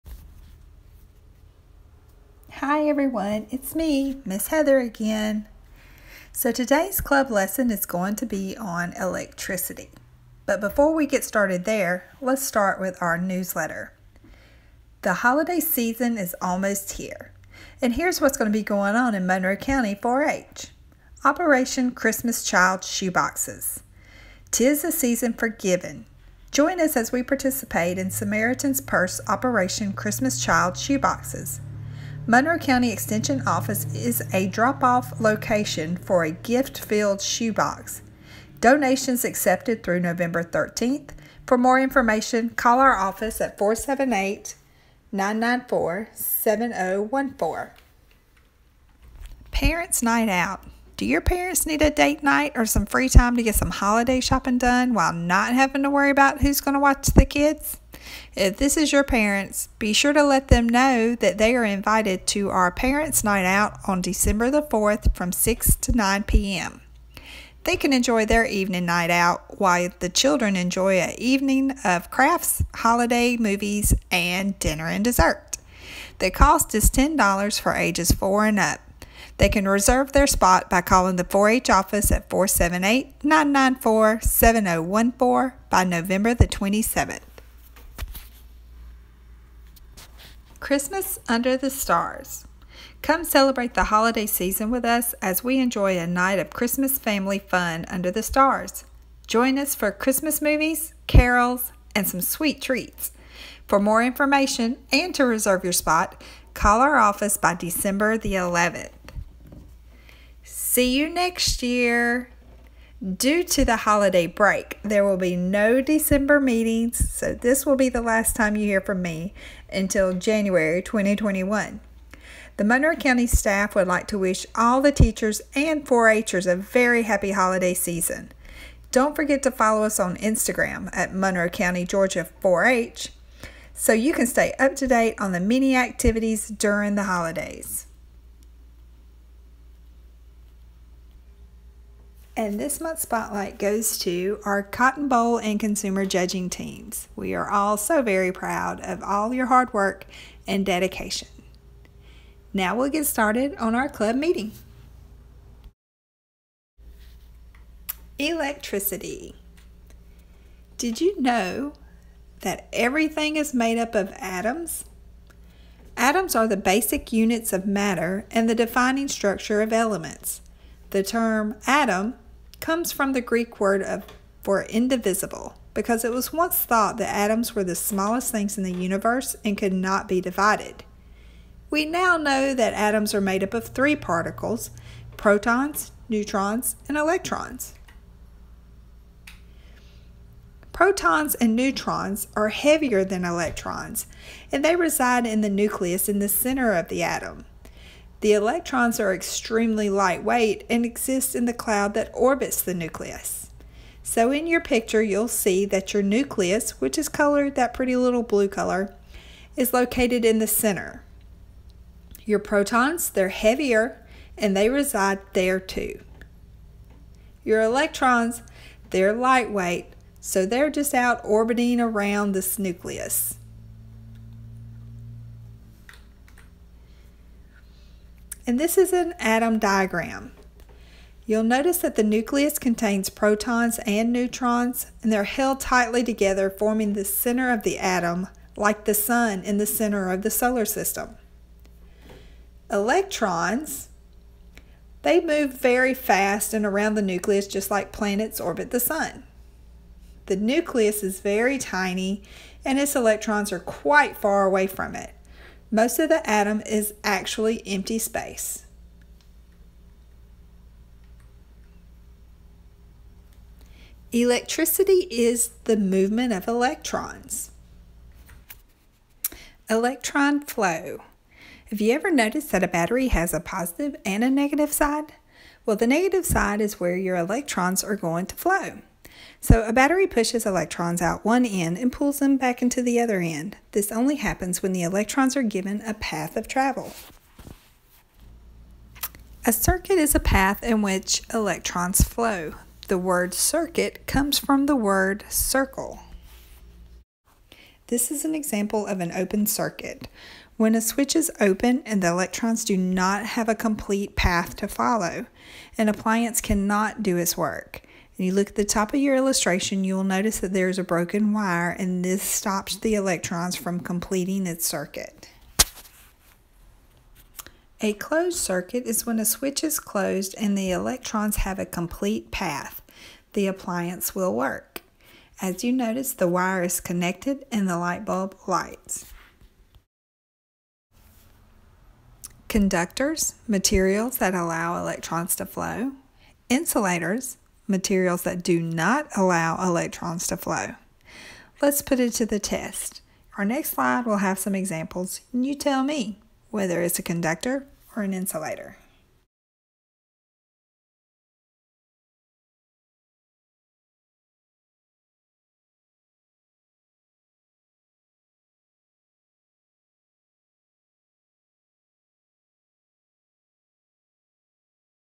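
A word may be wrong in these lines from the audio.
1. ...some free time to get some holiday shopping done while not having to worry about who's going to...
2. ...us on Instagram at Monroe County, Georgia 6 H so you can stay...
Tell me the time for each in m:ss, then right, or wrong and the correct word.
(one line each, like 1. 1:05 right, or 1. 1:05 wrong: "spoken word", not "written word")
1. 0:52 right
2. 2:09 wrong: "4", not "6".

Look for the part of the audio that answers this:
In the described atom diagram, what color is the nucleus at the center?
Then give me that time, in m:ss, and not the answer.
3:28.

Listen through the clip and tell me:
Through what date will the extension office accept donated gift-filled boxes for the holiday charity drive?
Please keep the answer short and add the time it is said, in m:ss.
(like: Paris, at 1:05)
November 13th, at 0:40.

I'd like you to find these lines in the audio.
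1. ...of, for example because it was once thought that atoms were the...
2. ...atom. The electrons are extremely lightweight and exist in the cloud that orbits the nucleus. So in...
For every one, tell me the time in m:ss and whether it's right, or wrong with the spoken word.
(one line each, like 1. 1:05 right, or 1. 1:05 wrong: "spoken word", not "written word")
1. 2:53 wrong: "indivisible", not "example"
2. 3:17 right.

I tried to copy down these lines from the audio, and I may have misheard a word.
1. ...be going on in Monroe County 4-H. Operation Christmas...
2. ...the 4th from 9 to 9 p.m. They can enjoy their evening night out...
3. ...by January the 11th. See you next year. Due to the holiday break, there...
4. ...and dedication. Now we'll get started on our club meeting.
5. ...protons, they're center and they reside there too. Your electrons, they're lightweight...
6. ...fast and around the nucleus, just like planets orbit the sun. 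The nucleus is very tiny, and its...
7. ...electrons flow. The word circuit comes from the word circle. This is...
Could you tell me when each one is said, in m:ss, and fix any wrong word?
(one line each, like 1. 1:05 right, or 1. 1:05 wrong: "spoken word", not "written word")
1. 0:18 right
2. 1:04 wrong: "6", not "9"
3. 1:47 wrong: "December", not "January"
4. 2:30 right
5. 3:32 wrong: "heavier", not "center"
6. 4:05 right
7. 4:51 right.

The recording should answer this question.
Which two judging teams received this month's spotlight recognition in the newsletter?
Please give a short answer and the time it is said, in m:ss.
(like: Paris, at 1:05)
Cotton Boll and consumer, at 2:24.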